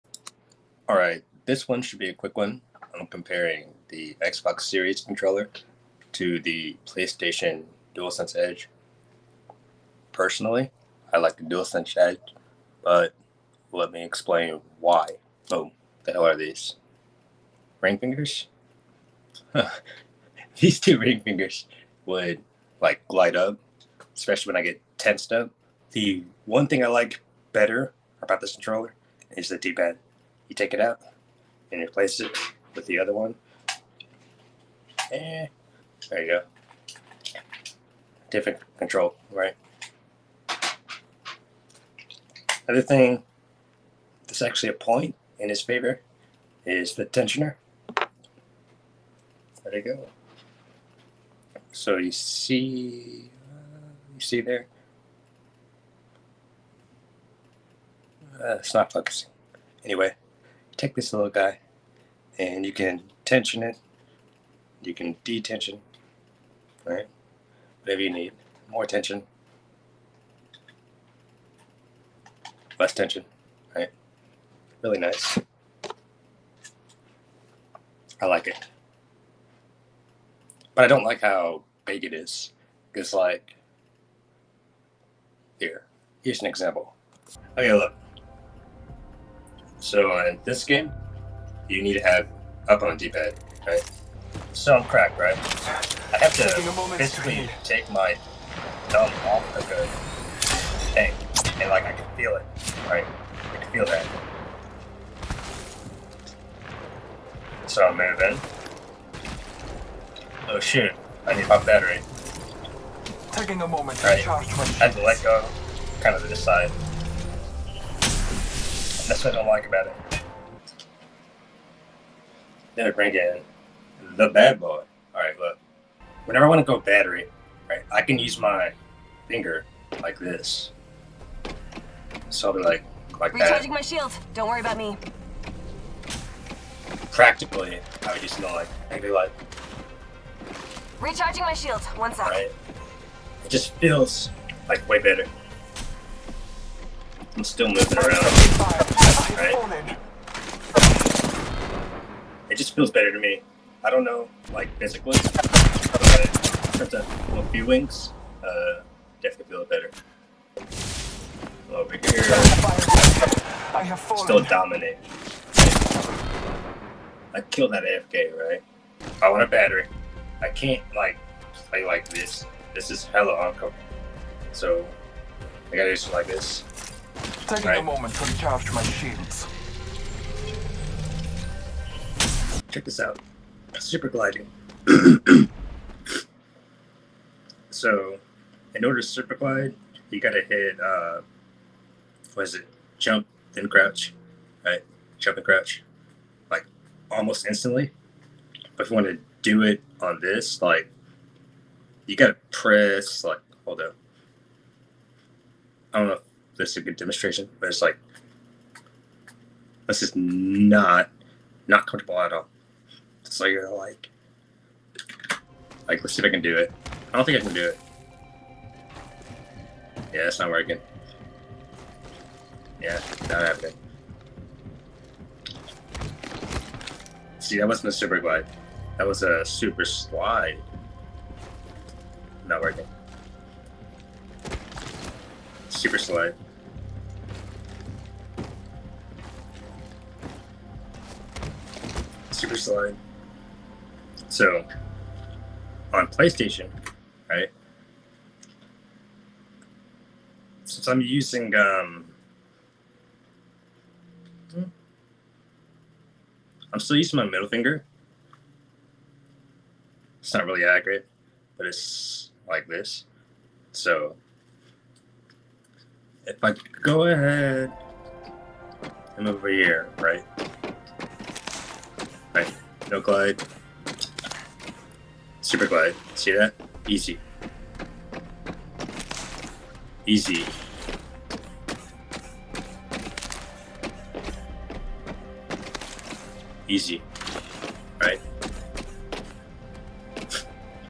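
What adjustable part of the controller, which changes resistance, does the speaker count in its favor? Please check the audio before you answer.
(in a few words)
Tensioner.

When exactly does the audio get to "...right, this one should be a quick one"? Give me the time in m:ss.
0:00.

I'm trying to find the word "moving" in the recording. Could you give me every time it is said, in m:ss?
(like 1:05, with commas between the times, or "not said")
1:47, 2:27.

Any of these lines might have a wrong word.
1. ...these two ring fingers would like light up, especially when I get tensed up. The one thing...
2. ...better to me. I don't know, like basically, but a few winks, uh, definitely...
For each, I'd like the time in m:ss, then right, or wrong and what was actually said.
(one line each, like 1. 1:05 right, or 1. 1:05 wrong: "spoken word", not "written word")
1. 0:20 right
2. 2:32 wrong: "physically", not "basically".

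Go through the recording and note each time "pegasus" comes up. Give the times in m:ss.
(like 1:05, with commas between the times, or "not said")
not said.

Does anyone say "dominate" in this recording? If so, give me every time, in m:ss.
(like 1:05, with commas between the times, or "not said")
2:44.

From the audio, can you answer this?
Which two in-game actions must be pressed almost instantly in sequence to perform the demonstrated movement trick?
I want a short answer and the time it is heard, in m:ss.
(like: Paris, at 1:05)
Jump, then crouch, at 3:12.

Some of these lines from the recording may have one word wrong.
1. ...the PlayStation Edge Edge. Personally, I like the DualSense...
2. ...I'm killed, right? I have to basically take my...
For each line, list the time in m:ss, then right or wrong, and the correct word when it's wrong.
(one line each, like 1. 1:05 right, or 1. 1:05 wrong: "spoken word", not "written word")
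1. 0:06 wrong: "DualSense", not "Edge"
2. 1:34 wrong: "cracked", not "killed".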